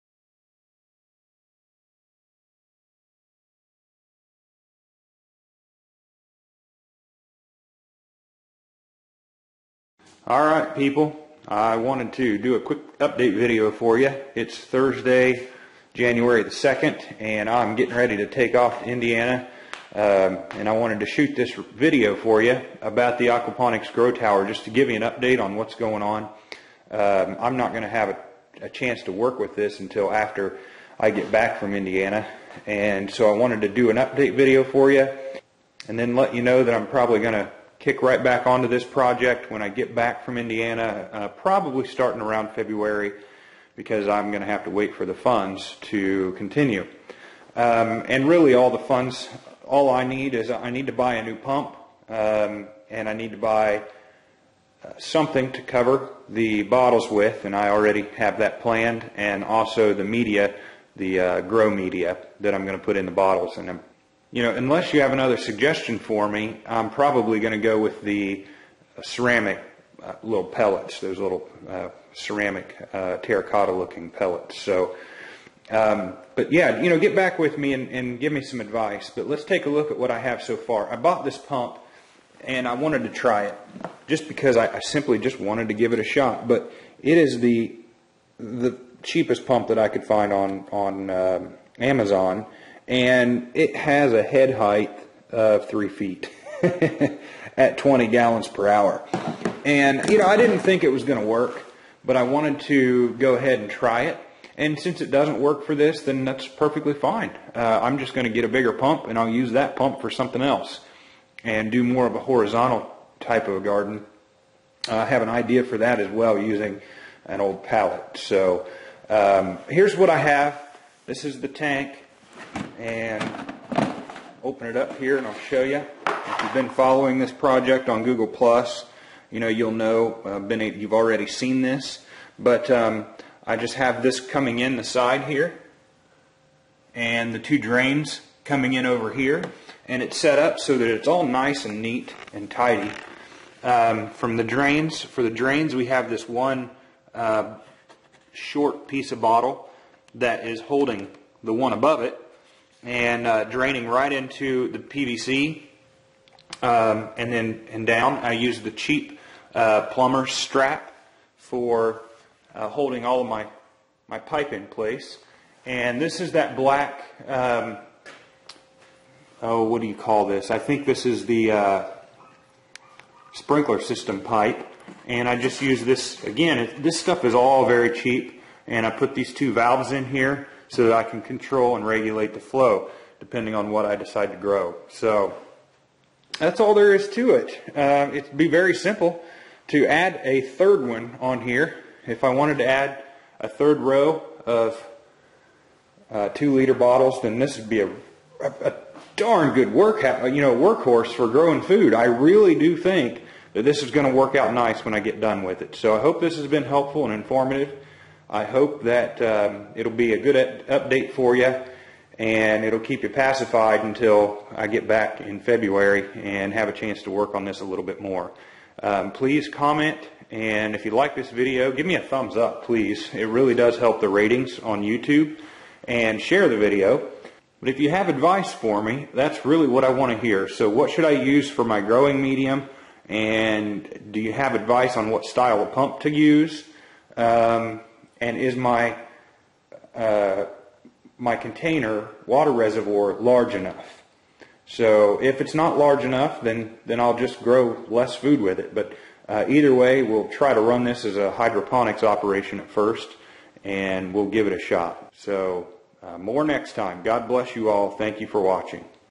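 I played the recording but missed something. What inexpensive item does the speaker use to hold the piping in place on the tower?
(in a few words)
Plumber strap.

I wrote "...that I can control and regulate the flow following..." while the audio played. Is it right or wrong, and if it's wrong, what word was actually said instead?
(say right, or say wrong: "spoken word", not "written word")
wrong: "depending", not "following".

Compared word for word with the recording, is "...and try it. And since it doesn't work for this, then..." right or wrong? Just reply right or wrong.
right.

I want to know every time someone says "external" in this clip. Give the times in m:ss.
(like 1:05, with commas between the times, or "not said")
not said.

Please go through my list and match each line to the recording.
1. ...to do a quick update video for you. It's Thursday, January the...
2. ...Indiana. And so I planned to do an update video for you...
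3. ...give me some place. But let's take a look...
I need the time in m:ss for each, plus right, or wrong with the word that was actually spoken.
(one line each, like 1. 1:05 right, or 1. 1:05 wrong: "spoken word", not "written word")
1. 0:12 right
2. 0:31 wrong: "wanted", not "planned"
3. 1:18 wrong: "advice", not "place".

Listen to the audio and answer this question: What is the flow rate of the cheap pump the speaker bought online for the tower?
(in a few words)
20 gallons per hour.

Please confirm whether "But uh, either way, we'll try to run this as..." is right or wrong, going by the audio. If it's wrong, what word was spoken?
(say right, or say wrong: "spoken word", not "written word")
right.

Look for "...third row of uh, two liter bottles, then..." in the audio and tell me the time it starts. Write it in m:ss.
3:13.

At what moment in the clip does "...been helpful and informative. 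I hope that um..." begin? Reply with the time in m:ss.
3:26.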